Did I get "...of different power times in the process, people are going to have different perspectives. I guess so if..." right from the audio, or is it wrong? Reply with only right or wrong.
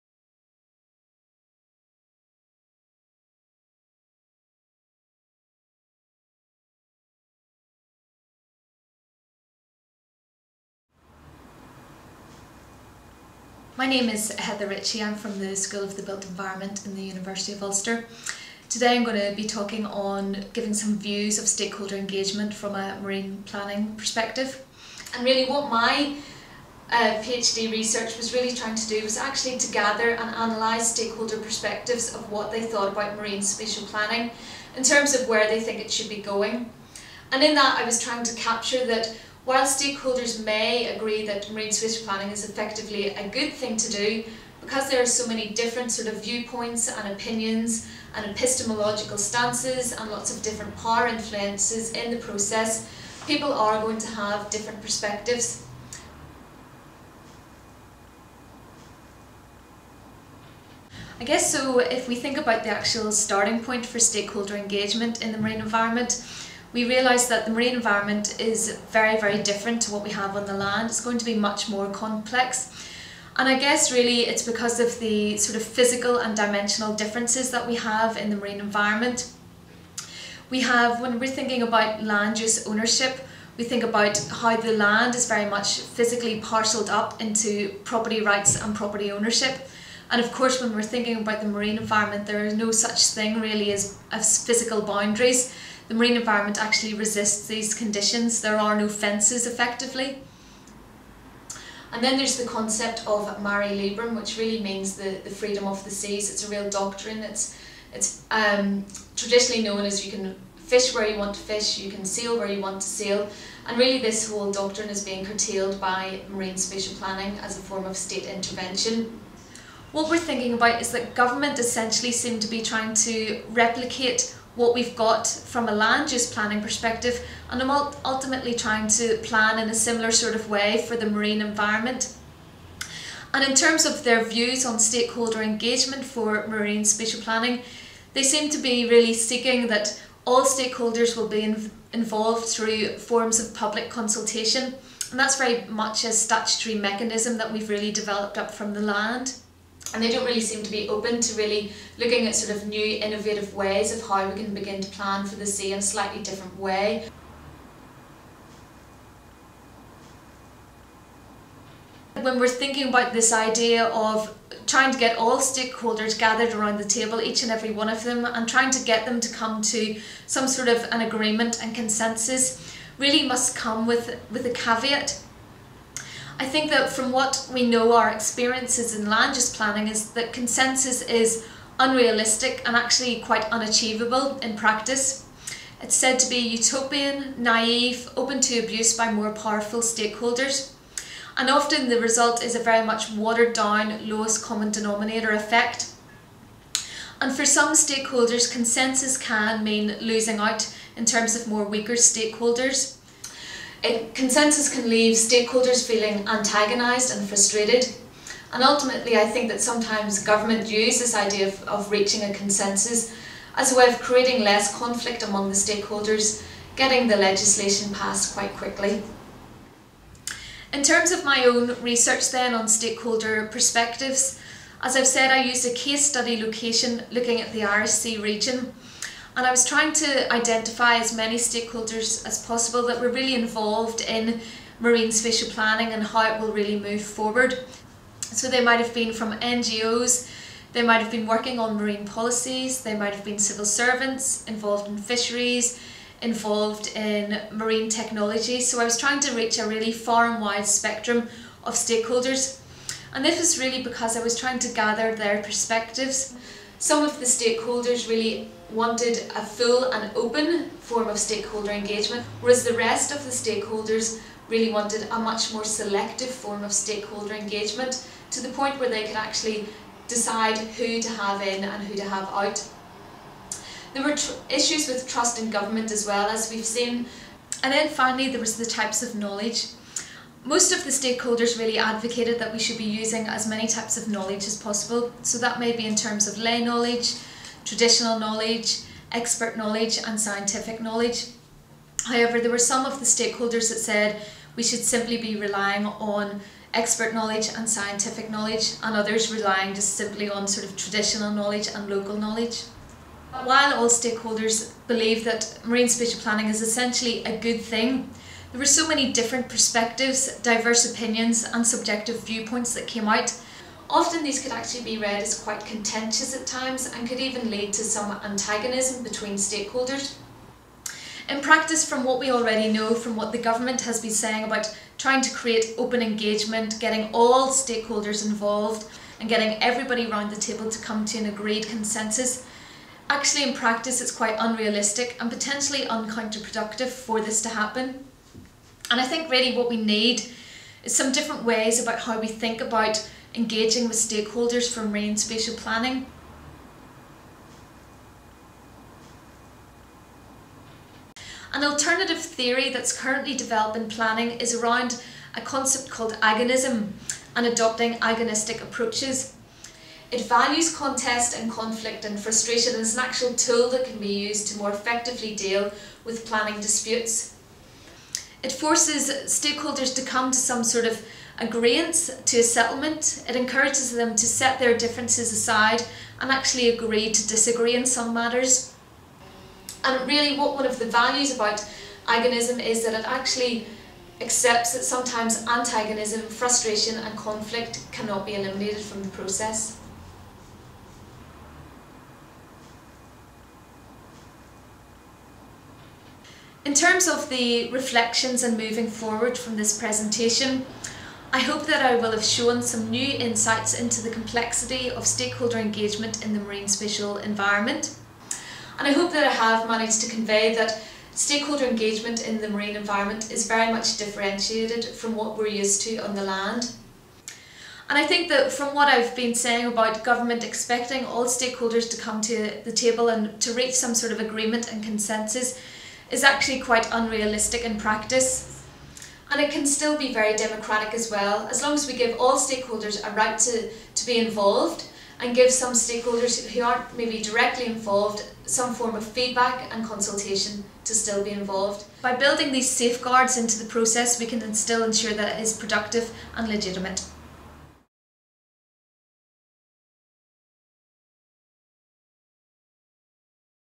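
wrong.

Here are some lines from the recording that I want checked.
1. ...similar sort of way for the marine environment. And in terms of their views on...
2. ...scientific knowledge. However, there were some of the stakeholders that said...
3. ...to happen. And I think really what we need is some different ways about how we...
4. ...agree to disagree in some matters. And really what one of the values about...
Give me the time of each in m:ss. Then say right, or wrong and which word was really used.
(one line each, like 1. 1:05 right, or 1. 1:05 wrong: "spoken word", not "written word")
1. 2:09 right
2. 4:50 right
3. 5:37 right
4. 6:16 right.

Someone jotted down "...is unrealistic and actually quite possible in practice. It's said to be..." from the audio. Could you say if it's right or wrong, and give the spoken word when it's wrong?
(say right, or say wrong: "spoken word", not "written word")
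wrong: "unachievable", not "possible".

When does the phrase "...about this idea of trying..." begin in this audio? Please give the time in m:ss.
2:42.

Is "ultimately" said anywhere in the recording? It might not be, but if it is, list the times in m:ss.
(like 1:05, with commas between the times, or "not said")
2:08, 3:28.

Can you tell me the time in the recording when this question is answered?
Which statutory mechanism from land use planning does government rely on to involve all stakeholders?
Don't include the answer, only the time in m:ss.
2:23.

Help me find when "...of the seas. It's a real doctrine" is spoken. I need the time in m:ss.
1:45.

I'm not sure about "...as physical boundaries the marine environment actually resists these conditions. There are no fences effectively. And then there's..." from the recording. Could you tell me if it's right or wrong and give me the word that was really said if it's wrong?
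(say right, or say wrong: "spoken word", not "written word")
right.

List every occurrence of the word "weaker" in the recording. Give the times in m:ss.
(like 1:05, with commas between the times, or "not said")
3:21.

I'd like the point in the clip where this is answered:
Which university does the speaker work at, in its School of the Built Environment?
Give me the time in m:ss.
0:17.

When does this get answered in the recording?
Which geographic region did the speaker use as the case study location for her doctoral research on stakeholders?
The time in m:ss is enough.
3:47.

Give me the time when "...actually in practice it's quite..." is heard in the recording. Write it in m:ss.
5:33.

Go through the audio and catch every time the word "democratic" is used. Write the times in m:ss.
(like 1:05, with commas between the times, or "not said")
7:10.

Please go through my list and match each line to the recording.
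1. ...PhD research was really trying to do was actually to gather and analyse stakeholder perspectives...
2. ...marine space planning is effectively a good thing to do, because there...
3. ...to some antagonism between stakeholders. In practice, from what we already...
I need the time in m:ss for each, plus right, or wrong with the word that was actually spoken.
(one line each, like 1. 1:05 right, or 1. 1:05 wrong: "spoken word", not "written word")
1. 0:27 right
2. 0:41 right
3. 5:17 right.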